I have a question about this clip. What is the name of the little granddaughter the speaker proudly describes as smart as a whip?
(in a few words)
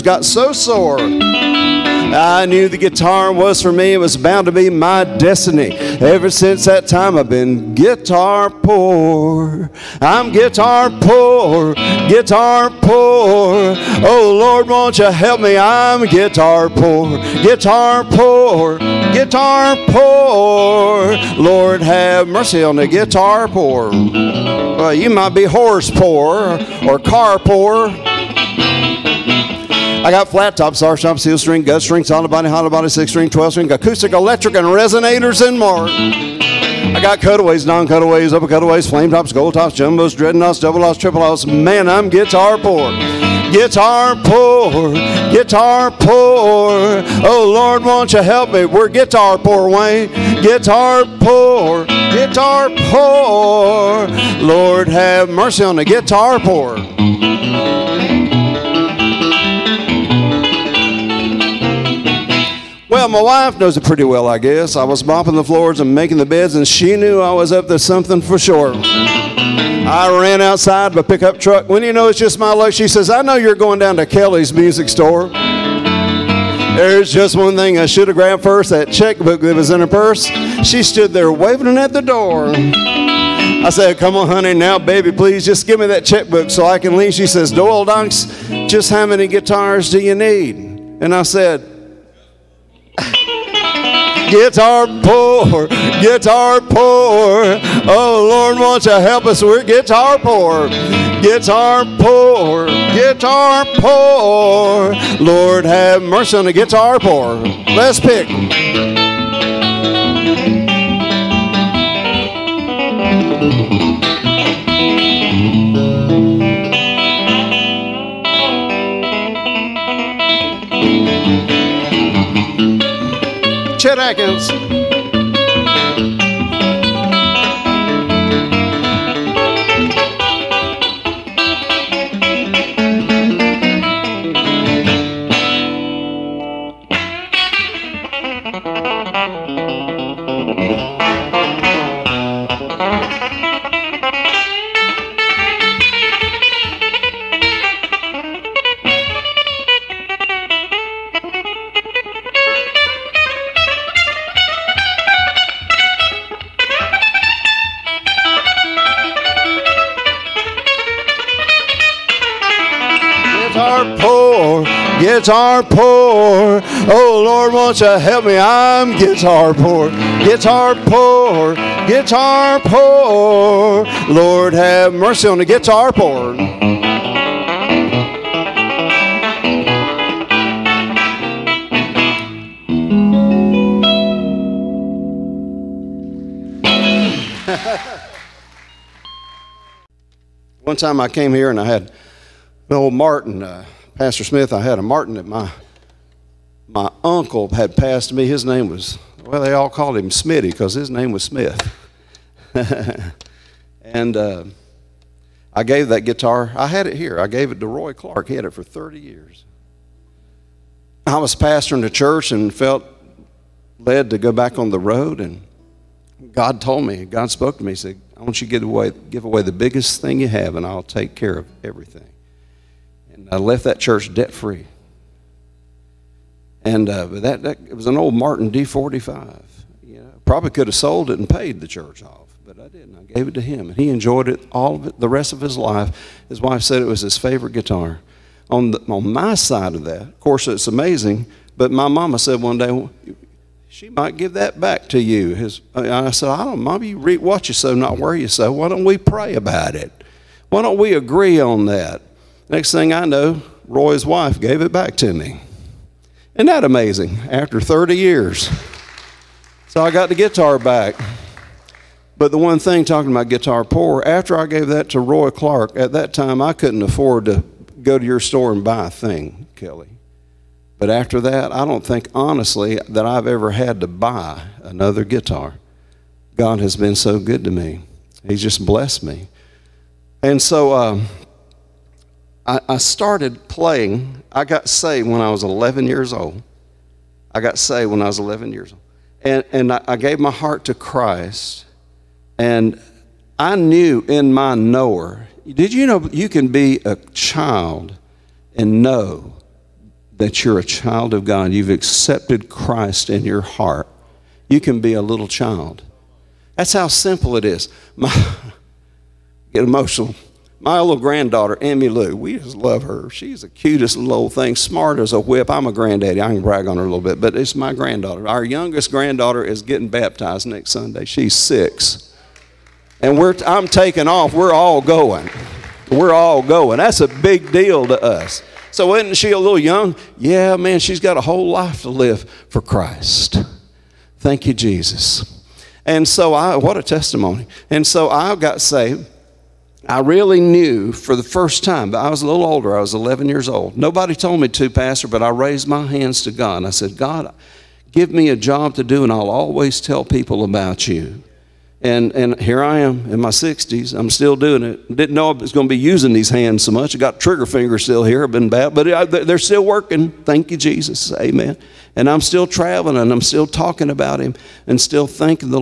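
Emmy Lou.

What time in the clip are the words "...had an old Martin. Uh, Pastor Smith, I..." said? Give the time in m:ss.
3:11.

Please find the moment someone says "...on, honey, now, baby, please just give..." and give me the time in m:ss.
1:24.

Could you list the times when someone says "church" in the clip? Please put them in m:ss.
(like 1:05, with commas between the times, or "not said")
3:31, 3:43, 3:51.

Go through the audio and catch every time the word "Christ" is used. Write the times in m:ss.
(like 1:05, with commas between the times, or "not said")
4:50, 5:02, 5:32.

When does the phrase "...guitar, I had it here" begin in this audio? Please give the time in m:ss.
3:26.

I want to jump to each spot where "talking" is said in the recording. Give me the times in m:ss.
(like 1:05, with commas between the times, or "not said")
4:22, 6:03.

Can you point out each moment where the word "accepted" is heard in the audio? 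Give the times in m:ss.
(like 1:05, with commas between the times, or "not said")
5:01.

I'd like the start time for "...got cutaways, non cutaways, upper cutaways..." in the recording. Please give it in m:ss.
0:36.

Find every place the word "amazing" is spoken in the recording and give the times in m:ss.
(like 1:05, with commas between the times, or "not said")
4:00, 4:16.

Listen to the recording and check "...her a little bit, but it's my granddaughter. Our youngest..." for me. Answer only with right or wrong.
right.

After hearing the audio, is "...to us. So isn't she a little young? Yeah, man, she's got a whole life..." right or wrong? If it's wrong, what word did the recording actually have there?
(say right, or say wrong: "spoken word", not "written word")
right.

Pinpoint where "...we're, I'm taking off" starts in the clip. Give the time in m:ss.
5:23.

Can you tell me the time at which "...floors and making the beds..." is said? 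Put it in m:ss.
1:05.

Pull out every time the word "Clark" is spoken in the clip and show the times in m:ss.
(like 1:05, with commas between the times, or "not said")
3:27, 4:25.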